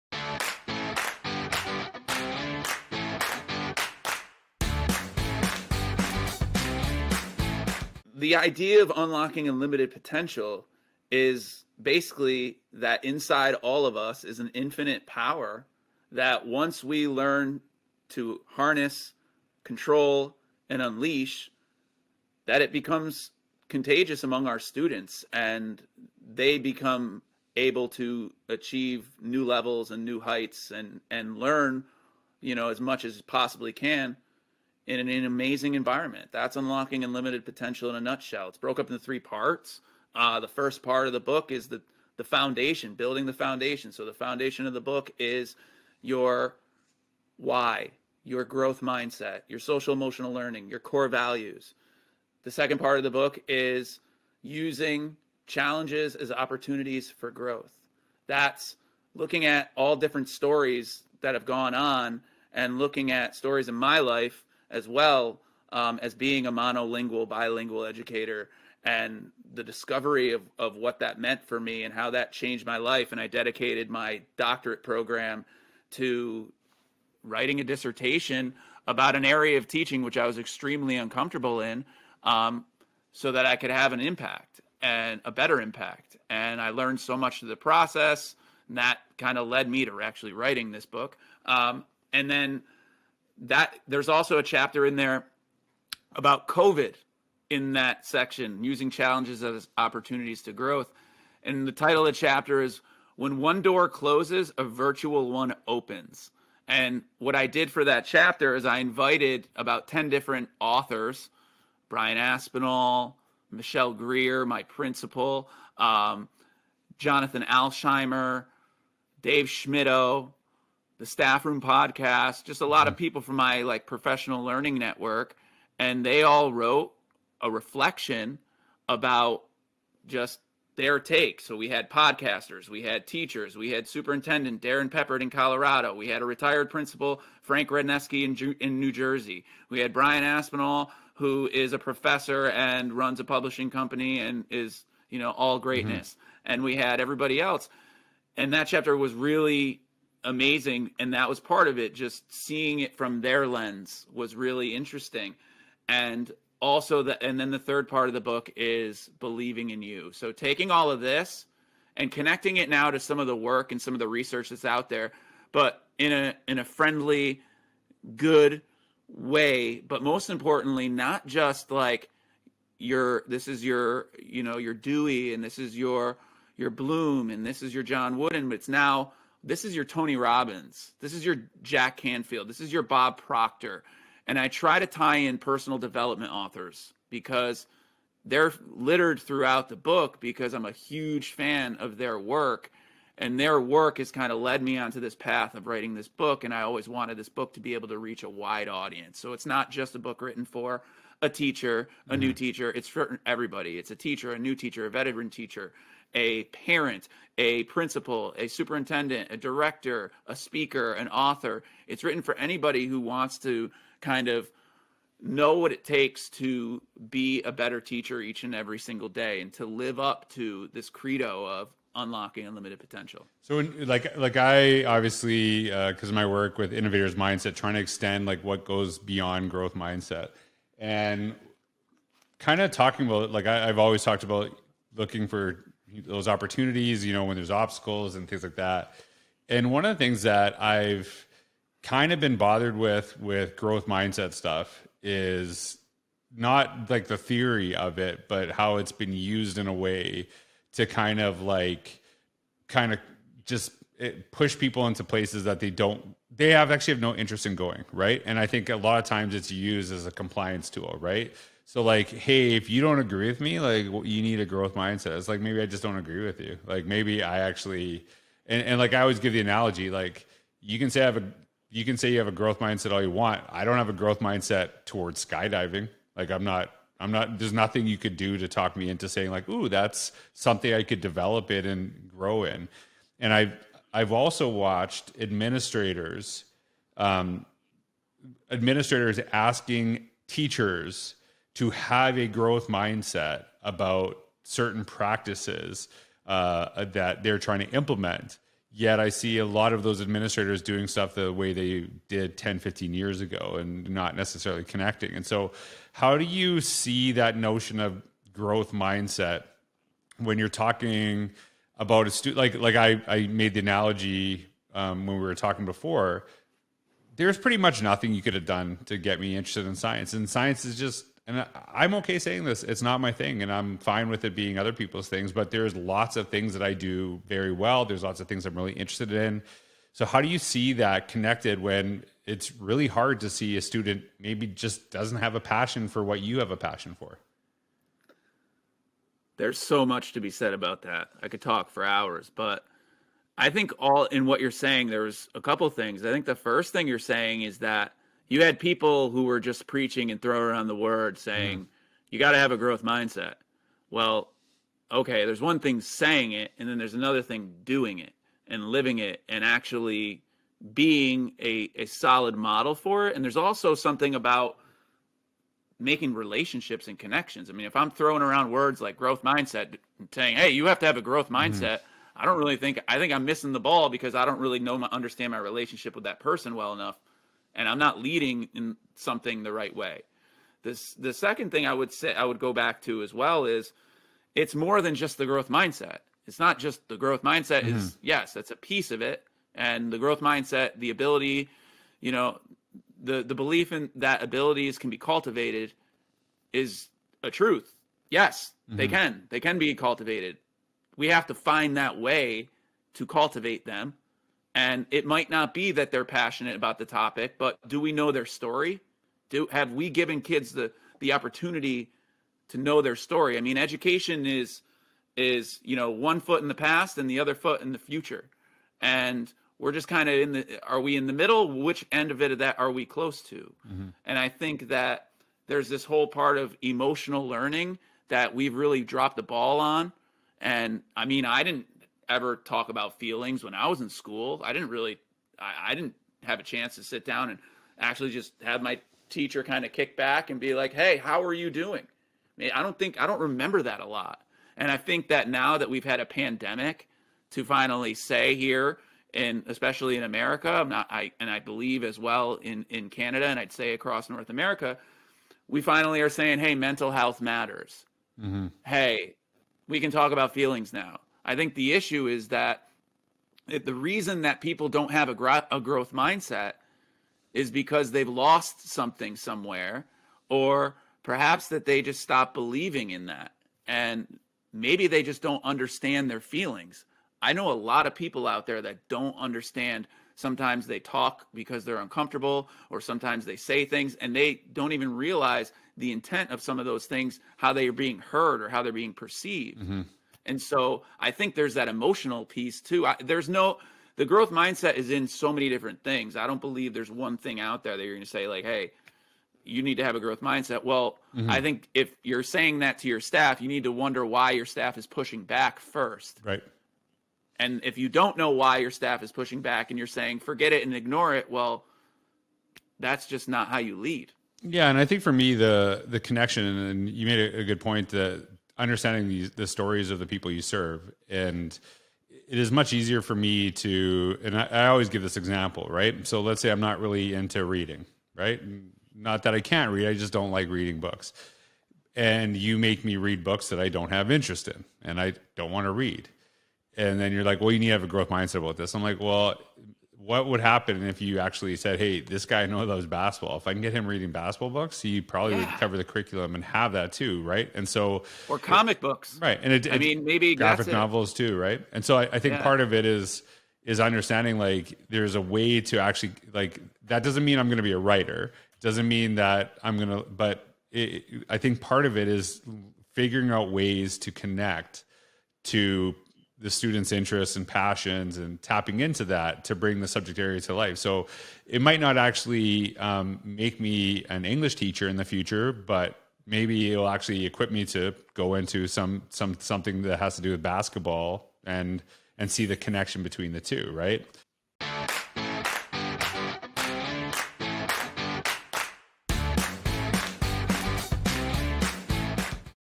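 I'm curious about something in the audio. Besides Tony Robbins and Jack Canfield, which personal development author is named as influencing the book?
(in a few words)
Bob Proctor.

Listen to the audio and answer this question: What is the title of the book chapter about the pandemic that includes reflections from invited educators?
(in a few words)
When One Door Closes, a Virtual One Opens.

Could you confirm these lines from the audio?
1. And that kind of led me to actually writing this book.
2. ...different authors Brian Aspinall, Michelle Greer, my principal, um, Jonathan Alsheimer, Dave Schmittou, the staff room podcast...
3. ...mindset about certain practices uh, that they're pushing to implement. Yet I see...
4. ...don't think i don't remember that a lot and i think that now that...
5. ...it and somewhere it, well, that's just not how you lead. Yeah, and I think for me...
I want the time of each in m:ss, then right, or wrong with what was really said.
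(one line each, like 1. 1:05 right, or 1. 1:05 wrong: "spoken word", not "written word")
1. 1:28 right
2. 1:50 right
3. 4:52 wrong: "trying", not "pushing"
4. 7:22 right
5. 8:30 wrong: "ignore", not "somewhere".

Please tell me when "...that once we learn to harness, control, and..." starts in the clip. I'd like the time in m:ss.
0:16.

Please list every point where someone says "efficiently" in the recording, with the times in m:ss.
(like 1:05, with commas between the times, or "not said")
not said.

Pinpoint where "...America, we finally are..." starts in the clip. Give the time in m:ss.
7:34.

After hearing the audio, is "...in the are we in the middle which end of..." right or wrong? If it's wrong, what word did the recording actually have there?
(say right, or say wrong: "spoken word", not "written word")
right.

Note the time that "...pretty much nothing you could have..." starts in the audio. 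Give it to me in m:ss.
5:17.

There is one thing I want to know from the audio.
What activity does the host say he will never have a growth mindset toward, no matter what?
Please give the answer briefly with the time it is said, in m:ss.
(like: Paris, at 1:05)
skydiving, at 4:35.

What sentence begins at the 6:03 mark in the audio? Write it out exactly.
And there's also something about making relationships and connections.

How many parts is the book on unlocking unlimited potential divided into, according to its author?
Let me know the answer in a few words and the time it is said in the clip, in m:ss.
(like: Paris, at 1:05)
3, at 0:39.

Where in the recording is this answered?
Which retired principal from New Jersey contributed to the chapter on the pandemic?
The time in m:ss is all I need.
2:17.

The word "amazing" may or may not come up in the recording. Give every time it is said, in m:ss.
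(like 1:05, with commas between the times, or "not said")
0:35, 2:30.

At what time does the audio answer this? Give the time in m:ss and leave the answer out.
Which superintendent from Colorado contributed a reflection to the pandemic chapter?
2:14.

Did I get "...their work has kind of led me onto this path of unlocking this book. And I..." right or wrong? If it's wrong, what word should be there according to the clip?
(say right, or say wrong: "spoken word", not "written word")
wrong: "writing", not "unlocking".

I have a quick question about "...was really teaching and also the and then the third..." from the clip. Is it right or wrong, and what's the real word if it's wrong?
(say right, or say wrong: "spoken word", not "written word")
wrong: "interesting", not "teaching".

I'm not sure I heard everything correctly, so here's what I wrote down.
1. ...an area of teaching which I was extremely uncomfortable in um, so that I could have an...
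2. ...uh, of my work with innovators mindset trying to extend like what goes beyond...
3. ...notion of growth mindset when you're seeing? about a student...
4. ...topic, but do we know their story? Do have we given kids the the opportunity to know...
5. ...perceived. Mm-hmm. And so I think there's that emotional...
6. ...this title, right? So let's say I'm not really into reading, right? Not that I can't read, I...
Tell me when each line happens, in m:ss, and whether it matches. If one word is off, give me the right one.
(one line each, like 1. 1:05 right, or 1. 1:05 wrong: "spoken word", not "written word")
1. 1:19 right
2. 3:46 right
3. 5:07 wrong: "talking", not "seeing"
4. 6:46 right
5. 8:08 right
6. 8:45 wrong: "example", not "title".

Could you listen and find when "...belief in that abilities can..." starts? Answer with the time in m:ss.
6:33.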